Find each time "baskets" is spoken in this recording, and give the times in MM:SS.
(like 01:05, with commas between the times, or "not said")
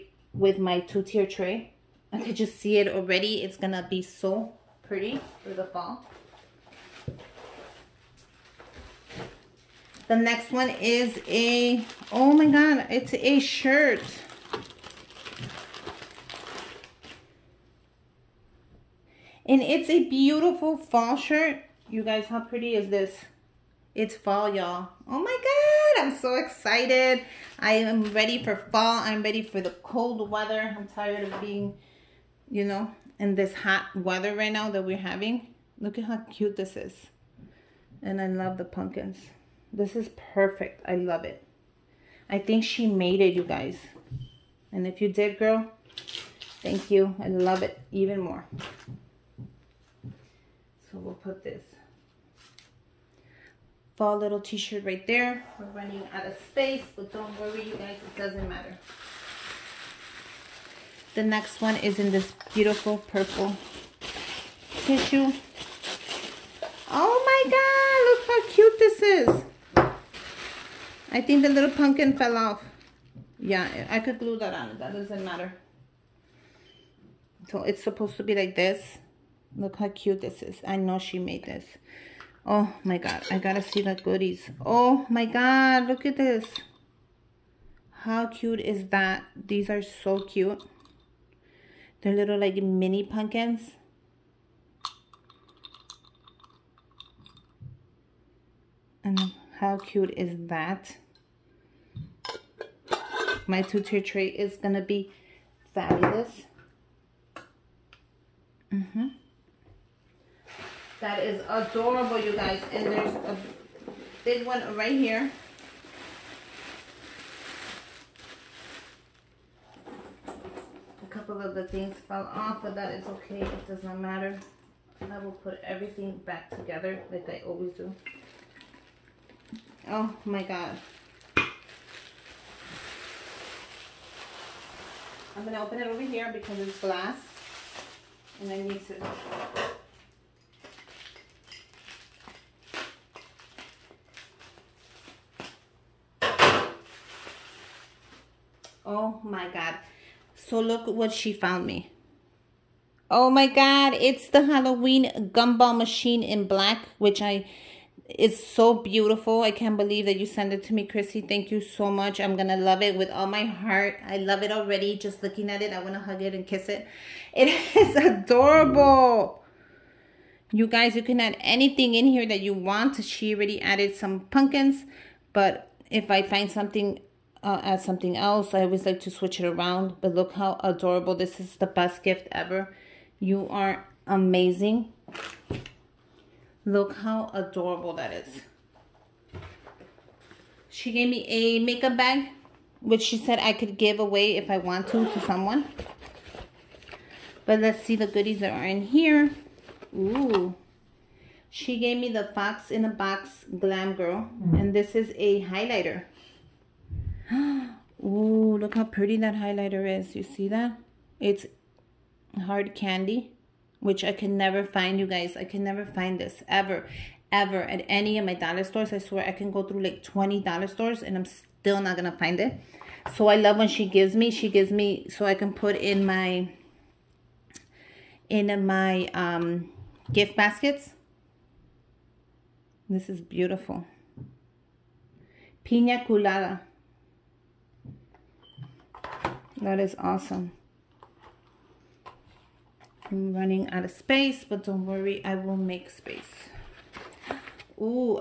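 03:50.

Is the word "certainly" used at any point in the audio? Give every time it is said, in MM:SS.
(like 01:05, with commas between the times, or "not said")
not said.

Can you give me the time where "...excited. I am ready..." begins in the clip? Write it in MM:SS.
00:26.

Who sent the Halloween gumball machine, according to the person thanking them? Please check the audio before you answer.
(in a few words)
Chrissy.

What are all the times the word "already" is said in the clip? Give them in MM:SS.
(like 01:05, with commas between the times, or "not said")
00:02, 02:44, 02:53.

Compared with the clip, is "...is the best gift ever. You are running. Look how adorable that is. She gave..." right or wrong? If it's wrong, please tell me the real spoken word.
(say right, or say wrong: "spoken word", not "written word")
wrong: "amazing", not "running".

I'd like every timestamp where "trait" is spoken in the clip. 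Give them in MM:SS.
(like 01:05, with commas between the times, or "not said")
not said.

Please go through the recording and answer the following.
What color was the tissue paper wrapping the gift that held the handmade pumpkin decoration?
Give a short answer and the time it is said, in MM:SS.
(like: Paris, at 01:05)
Purple, at 01:02.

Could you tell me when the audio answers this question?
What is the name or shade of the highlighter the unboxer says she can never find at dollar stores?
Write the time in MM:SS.
03:32.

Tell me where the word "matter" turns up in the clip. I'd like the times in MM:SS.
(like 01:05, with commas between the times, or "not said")
00:58, 01:15, 02:03.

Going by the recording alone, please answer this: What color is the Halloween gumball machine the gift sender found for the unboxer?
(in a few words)
Black.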